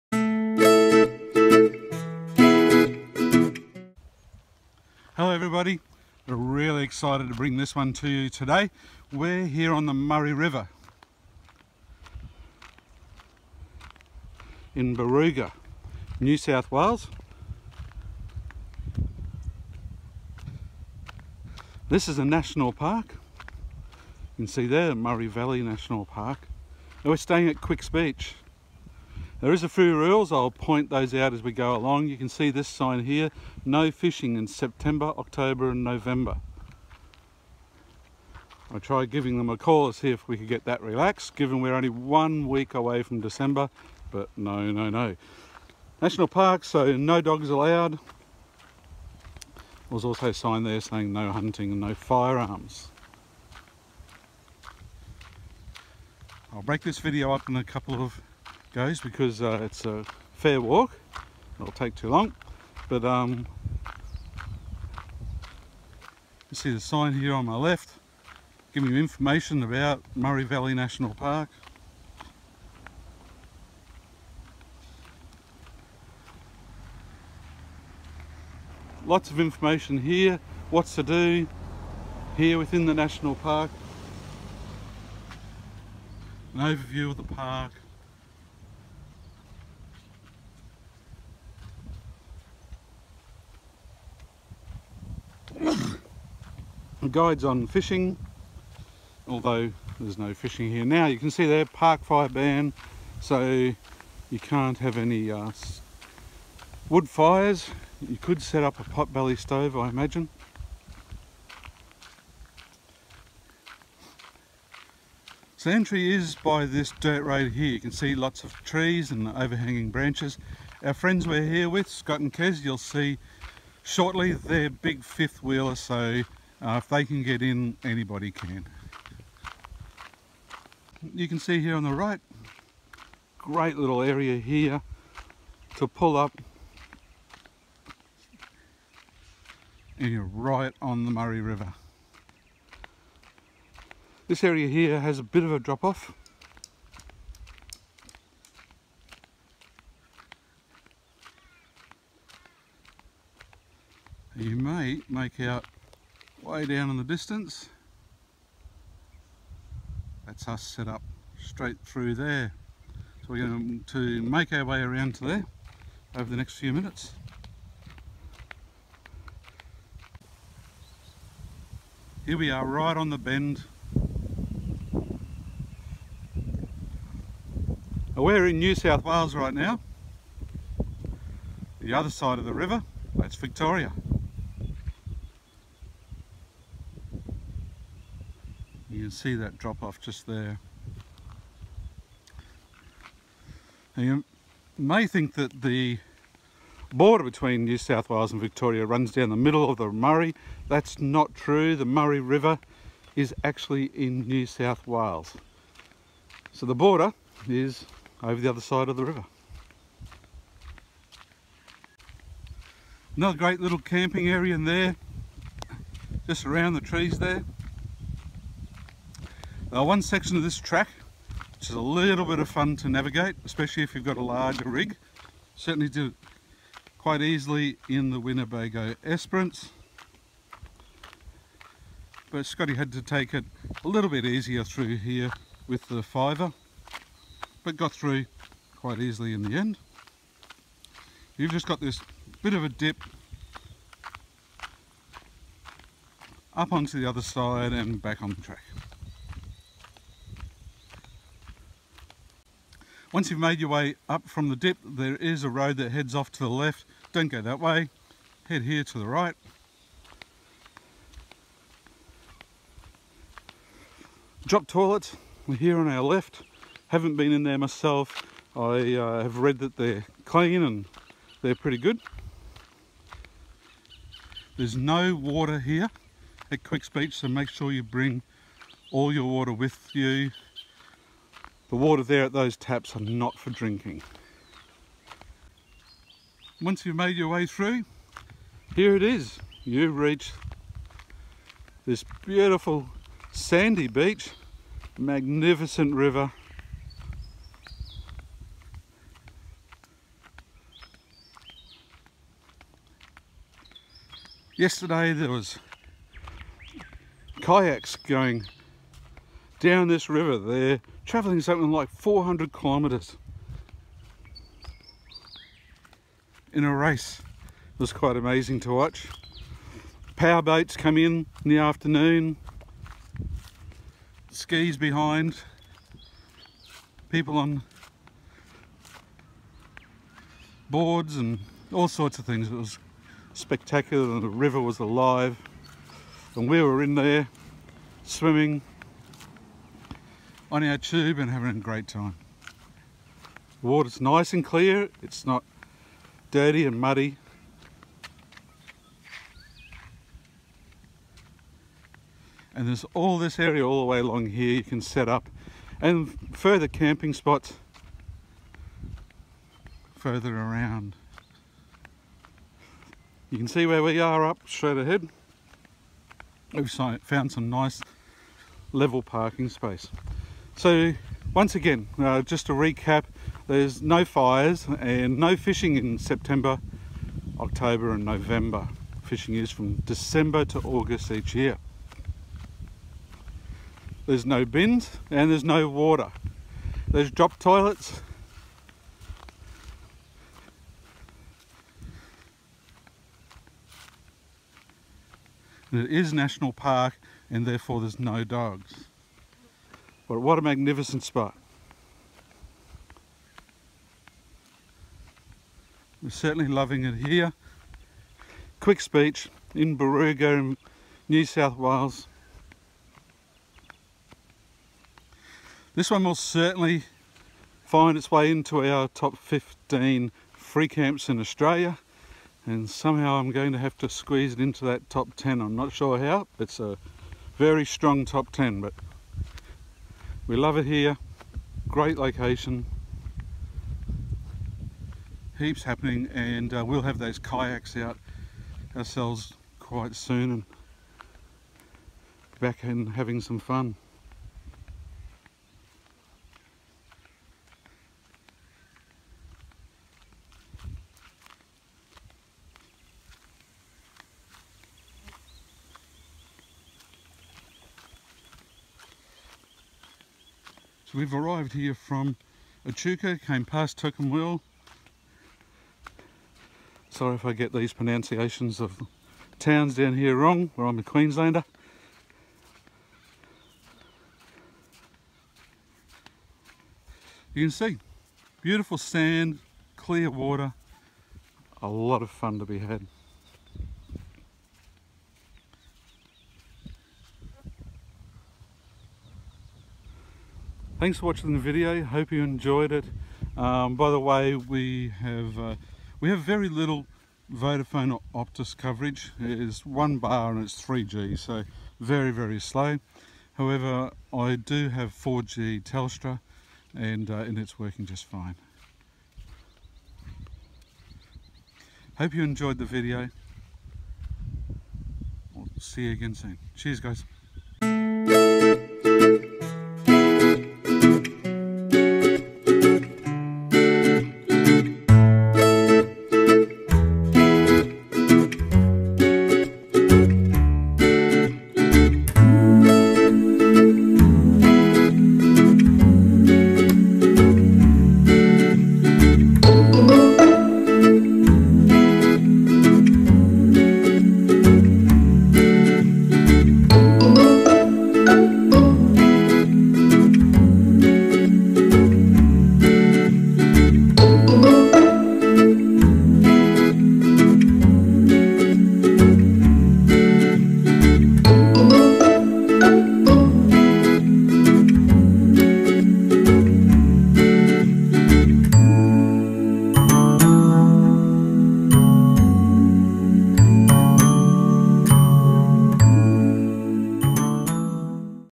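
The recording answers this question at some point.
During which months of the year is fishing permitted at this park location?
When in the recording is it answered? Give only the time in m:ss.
6:19.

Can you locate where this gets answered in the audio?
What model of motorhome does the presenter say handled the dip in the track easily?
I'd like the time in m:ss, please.
3:48.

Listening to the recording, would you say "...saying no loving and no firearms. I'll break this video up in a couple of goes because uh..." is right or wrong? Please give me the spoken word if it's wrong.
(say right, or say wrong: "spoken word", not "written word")
wrong: "hunting", not "loving".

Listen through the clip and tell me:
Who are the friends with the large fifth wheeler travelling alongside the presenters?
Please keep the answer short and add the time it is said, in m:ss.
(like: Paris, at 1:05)
Scott and Kez, at 2:01.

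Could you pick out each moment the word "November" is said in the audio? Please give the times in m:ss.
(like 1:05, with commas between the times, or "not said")
0:35, 6:18.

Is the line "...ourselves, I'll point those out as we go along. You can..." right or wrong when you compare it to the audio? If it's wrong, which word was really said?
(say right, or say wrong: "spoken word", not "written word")
wrong: "rules", not "ourselves".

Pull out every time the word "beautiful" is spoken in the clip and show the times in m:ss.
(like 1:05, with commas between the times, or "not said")
4:52, 7:58.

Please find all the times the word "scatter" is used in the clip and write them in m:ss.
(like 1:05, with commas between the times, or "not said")
not said.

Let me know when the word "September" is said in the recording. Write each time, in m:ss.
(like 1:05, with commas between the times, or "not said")
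0:34, 6:15.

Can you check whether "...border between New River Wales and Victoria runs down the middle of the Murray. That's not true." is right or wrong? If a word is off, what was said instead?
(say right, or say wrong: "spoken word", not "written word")
wrong: "South", not "River".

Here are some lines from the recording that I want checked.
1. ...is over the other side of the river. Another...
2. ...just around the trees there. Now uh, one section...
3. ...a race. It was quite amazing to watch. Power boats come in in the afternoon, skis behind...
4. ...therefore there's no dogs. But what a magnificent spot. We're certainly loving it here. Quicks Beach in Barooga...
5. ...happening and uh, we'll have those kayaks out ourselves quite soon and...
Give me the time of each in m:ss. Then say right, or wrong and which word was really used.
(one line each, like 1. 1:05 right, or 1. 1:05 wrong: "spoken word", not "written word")
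1. 3:27 right
2. 3:36 right
3. 5:16 right
4. 6:37 right
5. 7:15 right.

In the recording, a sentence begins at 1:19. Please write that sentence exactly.
Lots of information here, what's to do here within the national park.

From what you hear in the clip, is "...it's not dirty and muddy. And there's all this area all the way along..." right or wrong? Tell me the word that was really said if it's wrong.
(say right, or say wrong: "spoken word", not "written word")
right.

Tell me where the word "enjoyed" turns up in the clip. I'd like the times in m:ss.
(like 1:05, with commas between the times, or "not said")
8:12, 8:32.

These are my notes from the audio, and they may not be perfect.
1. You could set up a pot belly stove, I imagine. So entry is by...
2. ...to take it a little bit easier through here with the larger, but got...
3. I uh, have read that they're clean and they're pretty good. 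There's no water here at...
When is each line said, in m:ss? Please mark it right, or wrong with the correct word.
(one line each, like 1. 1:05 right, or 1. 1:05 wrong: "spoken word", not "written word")
1. 1:48 right
2. 3:52 wrong: "fiver", not "larger"
3. 4:28 right.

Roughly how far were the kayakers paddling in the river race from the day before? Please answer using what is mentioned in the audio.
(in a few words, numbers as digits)
400 kilometers.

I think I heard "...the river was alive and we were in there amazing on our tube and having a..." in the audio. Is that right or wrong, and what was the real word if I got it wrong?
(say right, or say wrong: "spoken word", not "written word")
wrong: "swimming", not "amazing".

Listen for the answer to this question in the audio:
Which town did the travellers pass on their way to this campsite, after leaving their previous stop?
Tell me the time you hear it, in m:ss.
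7:43.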